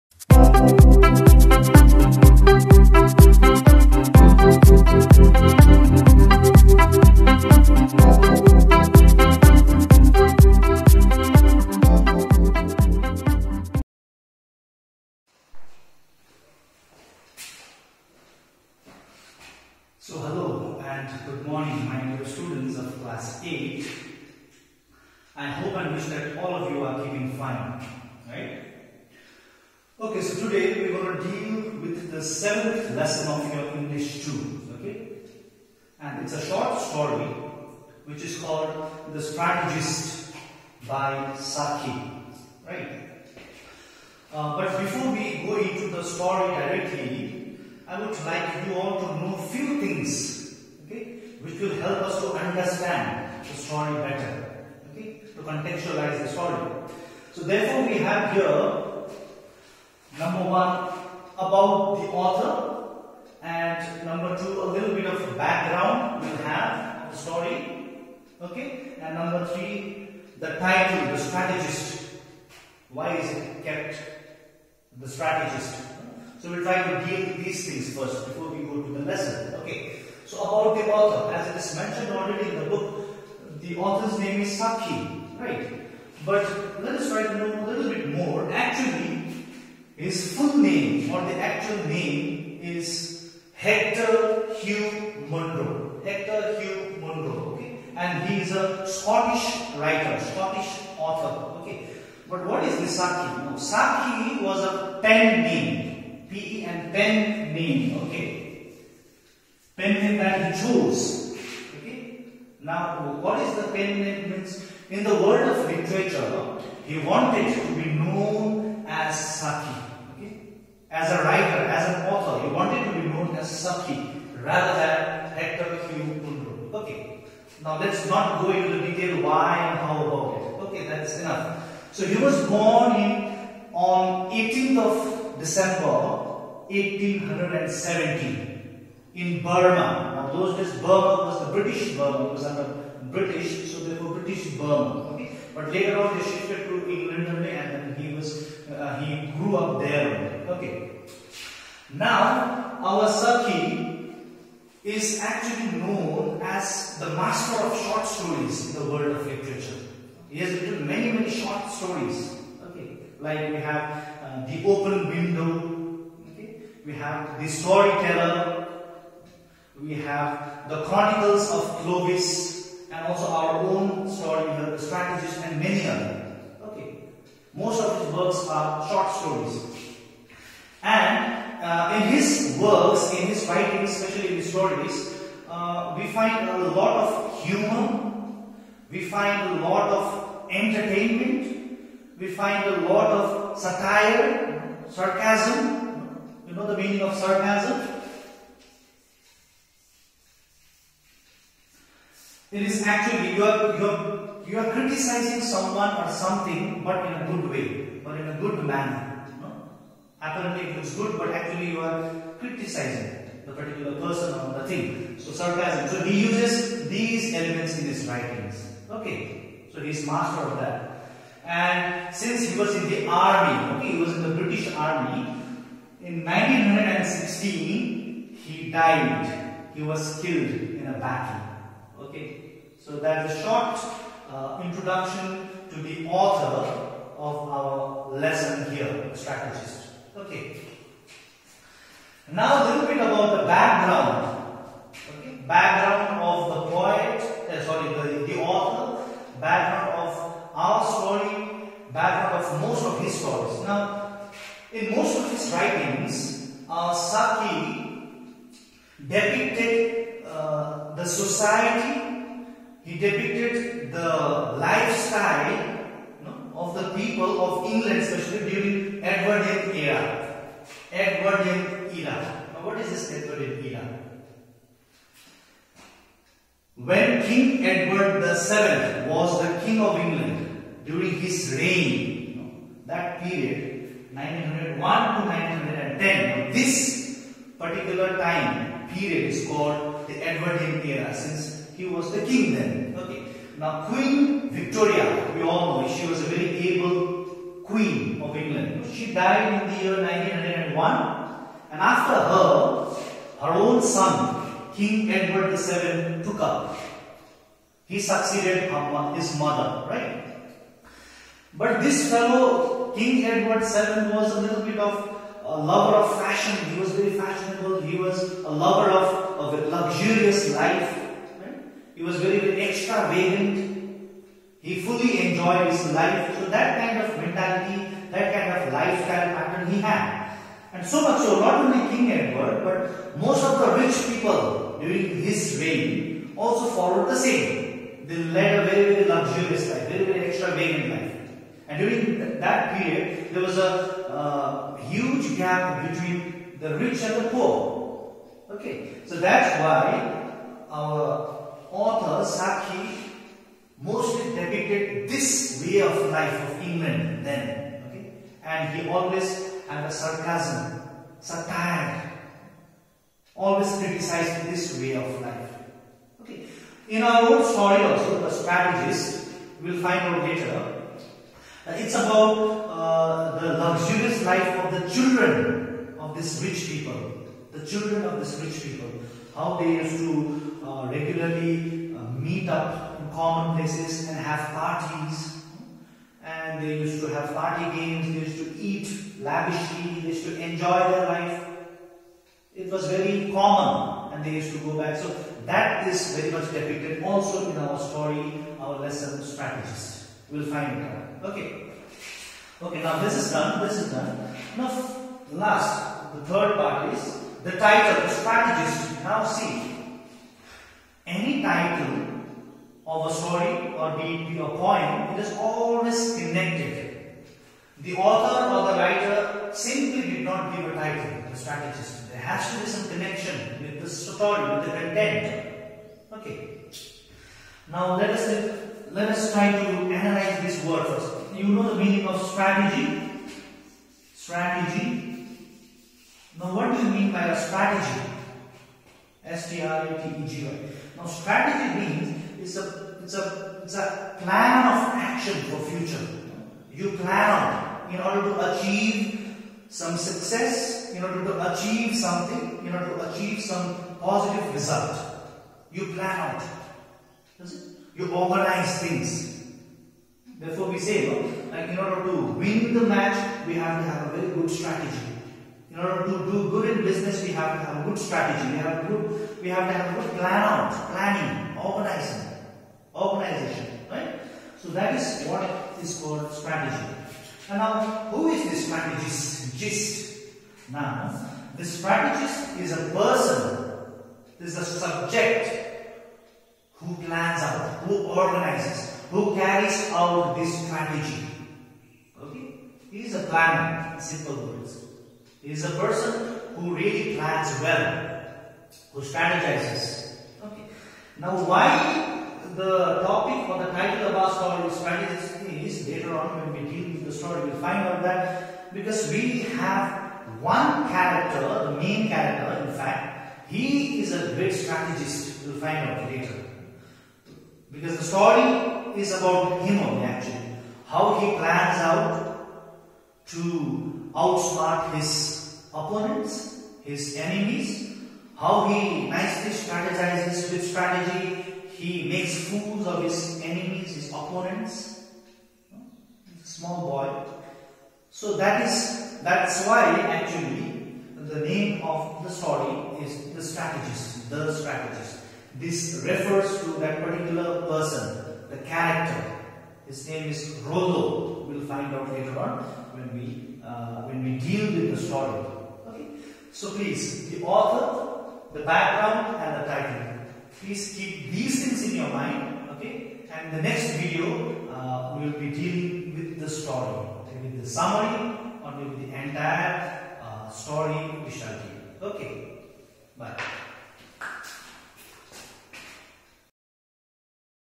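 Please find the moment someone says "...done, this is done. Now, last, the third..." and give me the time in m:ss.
6:43.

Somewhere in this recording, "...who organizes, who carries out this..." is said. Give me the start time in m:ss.
8:07.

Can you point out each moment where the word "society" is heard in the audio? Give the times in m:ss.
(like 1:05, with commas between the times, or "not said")
4:21.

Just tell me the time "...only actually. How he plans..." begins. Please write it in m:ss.
8:39.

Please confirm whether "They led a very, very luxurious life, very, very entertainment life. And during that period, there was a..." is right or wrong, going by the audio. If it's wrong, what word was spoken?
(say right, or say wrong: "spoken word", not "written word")
wrong: "extravagant", not "entertainment".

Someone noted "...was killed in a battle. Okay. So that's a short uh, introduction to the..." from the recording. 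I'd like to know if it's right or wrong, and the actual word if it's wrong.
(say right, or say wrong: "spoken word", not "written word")
right.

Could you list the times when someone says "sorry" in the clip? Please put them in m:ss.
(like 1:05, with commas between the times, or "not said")
4:07.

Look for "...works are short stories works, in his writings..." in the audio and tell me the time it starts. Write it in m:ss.
2:58.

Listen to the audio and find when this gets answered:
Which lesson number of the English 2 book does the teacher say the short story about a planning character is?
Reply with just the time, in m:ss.
0:32.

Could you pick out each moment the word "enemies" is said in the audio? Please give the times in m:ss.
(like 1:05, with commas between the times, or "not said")
8:47, 8:53.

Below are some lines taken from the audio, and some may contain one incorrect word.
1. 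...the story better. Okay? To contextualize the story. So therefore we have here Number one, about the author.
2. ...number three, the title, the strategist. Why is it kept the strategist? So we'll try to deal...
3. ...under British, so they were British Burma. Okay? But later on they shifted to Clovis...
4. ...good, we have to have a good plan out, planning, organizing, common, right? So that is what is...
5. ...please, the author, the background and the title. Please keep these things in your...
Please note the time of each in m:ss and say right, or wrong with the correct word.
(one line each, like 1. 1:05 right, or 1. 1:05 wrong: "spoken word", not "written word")
1. 0:53 right
2. 1:09 right
3. 2:22 wrong: "England", not "Clovis"
4. 7:48 wrong: "organization", not "common"
5. 9:16 right.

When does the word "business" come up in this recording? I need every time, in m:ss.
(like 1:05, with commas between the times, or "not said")
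7:46.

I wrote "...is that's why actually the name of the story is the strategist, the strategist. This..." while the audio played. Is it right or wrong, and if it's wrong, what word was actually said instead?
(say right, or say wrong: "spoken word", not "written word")
right.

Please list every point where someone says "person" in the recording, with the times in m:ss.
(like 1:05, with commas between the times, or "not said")
3:33, 8:02, 8:15, 9:07.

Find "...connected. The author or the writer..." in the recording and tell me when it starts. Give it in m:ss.
6:56.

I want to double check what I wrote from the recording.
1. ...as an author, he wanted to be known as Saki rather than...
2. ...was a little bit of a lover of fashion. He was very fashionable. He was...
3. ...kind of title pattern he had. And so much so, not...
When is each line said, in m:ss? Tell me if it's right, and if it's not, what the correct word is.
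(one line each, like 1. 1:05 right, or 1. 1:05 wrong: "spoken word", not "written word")
1. 2:01 right
2. 5:14 right
3. 5:28 wrong: "lifestyle", not "title".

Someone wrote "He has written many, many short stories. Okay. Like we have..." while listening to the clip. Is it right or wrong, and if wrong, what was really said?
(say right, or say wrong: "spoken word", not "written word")
right.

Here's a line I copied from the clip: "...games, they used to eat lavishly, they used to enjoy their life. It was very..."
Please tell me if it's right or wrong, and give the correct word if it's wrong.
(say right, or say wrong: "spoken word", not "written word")
right.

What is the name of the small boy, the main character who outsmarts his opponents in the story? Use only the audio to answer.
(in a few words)
Rollo.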